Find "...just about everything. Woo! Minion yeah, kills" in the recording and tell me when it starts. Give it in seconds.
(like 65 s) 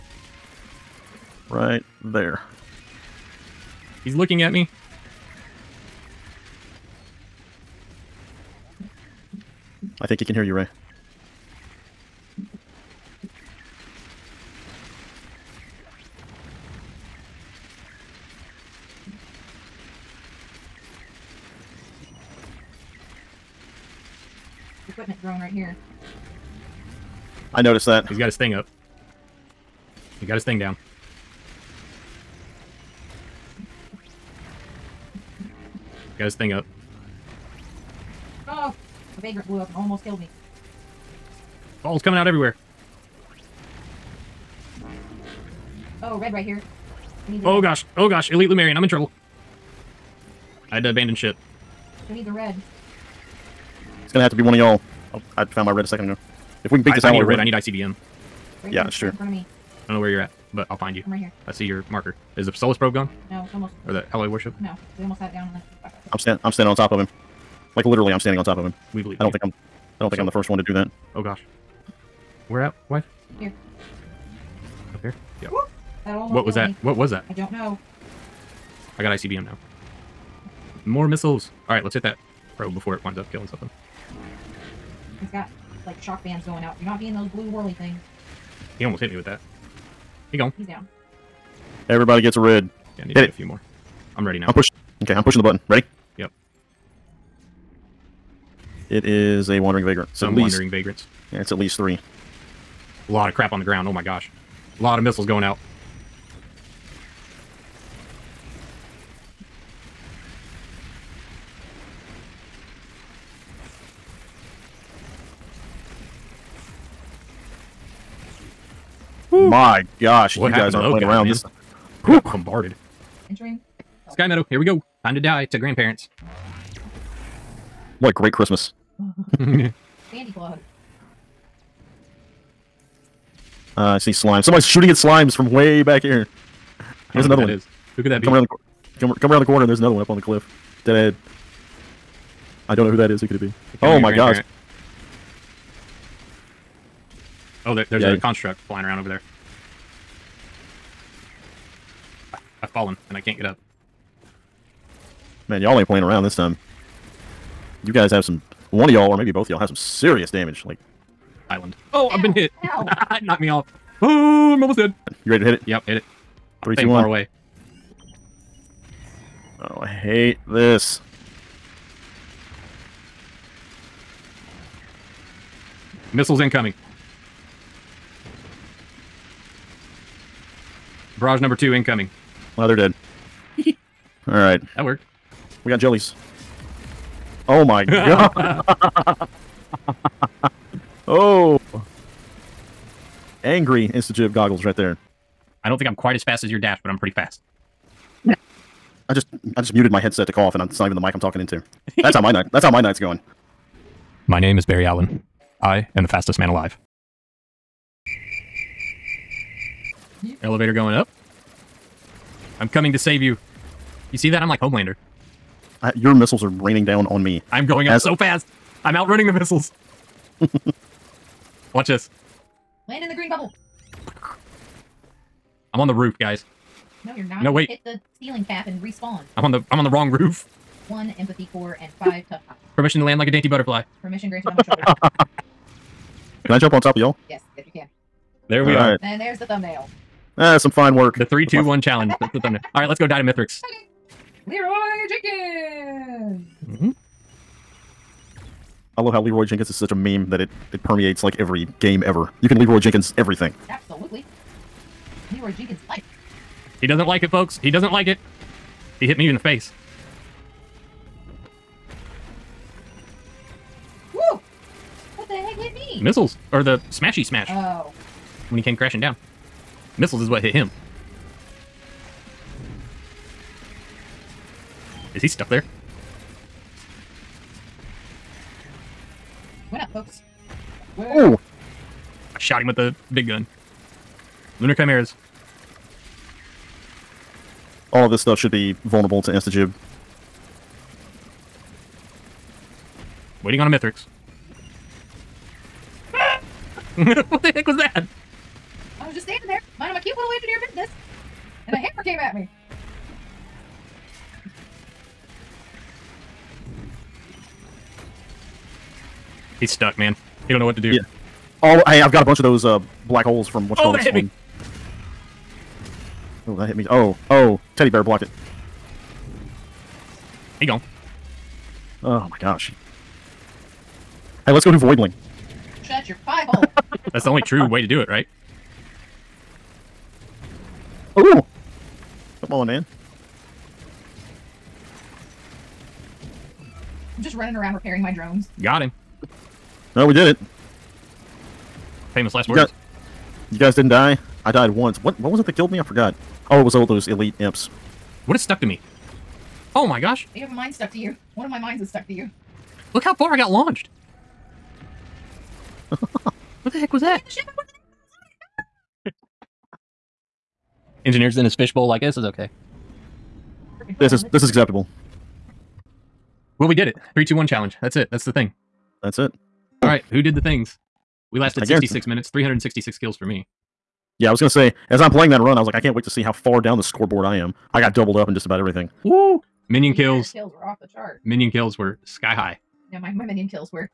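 378 s.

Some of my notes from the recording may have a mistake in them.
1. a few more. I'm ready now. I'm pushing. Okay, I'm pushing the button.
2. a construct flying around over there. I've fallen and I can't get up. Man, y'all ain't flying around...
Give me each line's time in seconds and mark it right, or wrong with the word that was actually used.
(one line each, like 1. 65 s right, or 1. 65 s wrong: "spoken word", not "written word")
1. 93 s right
2. 148 s wrong: "playing", not "flying".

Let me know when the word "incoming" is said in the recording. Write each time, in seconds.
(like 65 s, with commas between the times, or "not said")
176 s, 181 s.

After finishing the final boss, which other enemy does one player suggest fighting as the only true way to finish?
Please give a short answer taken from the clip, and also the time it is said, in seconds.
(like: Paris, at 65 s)
voidling, at 324 s.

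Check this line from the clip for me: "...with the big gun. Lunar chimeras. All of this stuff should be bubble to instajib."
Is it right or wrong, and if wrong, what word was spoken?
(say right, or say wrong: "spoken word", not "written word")
wrong: "vulnerable", not "bubble".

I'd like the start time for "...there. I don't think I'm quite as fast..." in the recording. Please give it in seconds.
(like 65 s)
194 s.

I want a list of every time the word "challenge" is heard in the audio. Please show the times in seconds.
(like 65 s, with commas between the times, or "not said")
241 s, 367 s.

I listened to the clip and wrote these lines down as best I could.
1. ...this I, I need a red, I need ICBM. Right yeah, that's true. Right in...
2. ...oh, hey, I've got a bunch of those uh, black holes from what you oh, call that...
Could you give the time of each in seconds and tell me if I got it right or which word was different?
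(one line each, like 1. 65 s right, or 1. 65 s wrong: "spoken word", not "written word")
1. 56 s right
2. 311 s right.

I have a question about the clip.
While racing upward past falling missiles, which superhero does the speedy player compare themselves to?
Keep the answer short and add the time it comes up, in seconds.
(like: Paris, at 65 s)
Homelander, at 214 s.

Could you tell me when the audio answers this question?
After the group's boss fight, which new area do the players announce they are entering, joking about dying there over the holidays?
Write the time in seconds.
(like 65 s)
124 s.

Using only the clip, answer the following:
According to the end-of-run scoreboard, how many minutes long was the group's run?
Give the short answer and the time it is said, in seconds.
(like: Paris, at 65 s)
66, at 371 s.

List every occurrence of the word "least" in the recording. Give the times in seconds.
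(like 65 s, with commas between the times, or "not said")
101 s.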